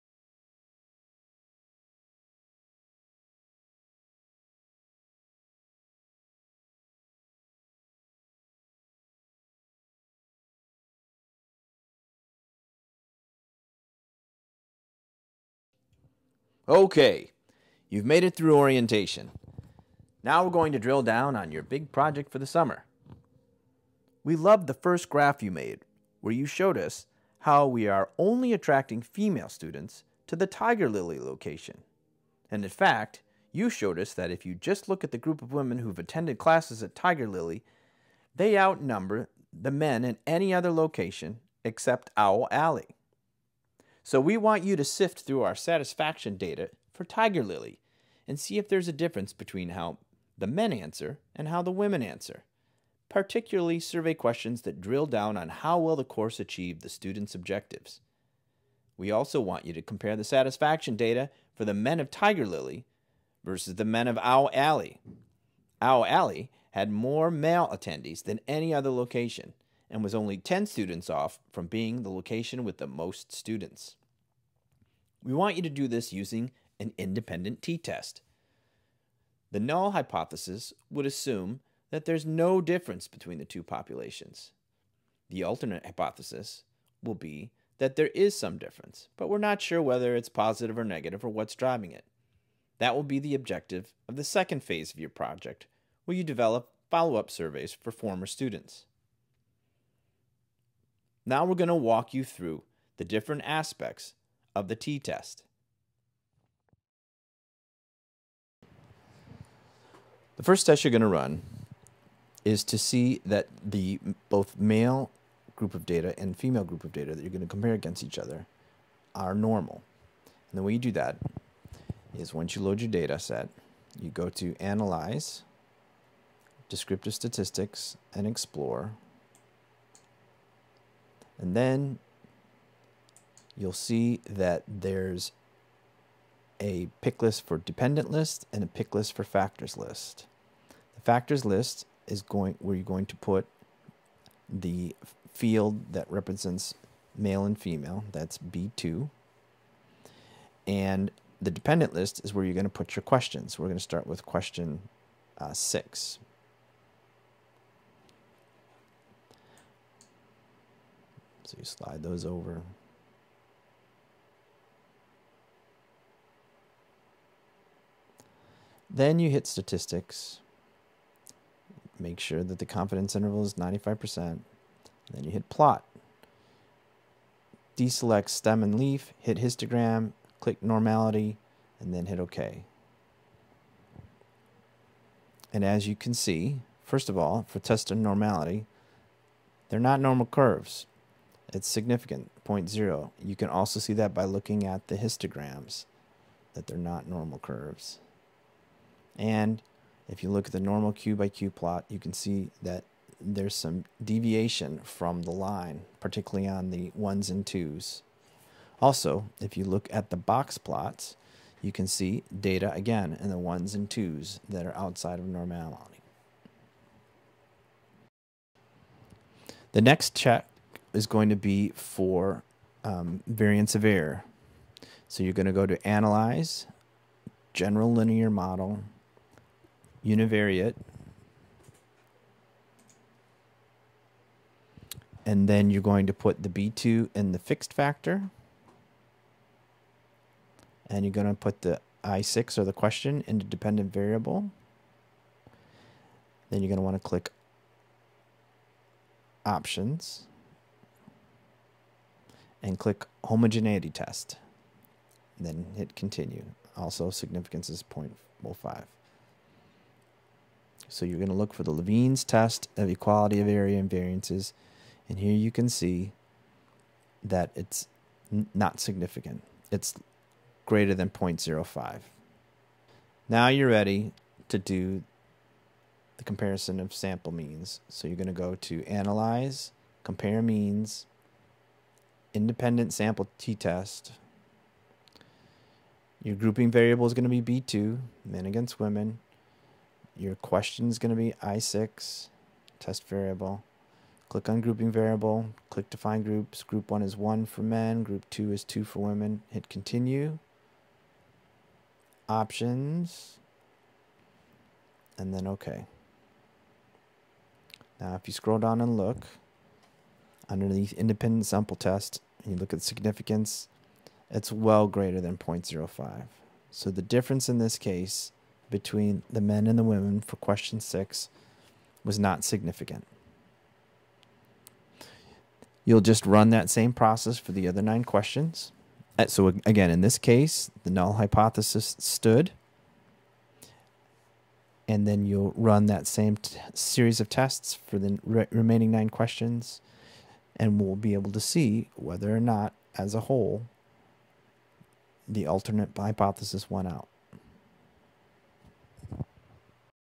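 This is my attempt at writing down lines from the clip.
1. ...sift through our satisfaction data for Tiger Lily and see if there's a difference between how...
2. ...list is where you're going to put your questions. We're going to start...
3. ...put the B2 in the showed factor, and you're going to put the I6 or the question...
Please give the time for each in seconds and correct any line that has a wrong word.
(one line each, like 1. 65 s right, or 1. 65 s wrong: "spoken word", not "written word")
1. 44 s right
2. 151 s right
3. 236 s wrong: "fixed", not "showed".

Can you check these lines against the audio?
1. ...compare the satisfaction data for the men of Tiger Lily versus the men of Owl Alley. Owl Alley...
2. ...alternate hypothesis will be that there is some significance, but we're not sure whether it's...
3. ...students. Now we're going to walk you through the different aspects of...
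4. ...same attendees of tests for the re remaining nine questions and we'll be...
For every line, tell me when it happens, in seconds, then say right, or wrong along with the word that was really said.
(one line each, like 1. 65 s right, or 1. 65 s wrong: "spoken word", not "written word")
1. 59 s right
2. 85 s wrong: "difference", not "significance"
3. 98 s right
4. 336 s wrong: "series", not "attendees".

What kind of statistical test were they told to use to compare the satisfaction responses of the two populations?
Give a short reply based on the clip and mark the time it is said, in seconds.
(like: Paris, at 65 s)
independent t-test, at 76 s.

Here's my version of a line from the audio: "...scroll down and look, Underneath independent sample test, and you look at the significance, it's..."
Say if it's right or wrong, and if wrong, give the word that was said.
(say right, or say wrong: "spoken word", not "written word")
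right.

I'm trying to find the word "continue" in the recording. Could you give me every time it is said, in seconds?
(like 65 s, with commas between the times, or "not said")
255 s, 299 s.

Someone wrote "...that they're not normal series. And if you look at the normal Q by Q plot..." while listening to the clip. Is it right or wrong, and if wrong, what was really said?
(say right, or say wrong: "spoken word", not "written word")
wrong: "curves", not "series".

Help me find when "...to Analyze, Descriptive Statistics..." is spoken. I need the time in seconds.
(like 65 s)
124 s.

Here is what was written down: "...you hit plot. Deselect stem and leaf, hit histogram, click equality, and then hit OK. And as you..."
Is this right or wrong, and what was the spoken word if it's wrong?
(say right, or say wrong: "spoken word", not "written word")
wrong: "normality", not "equality".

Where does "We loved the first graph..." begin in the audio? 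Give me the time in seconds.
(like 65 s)
24 s.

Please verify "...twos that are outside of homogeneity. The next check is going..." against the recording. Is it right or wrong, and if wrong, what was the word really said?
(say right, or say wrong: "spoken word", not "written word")
wrong: "normality", not "homogeneity".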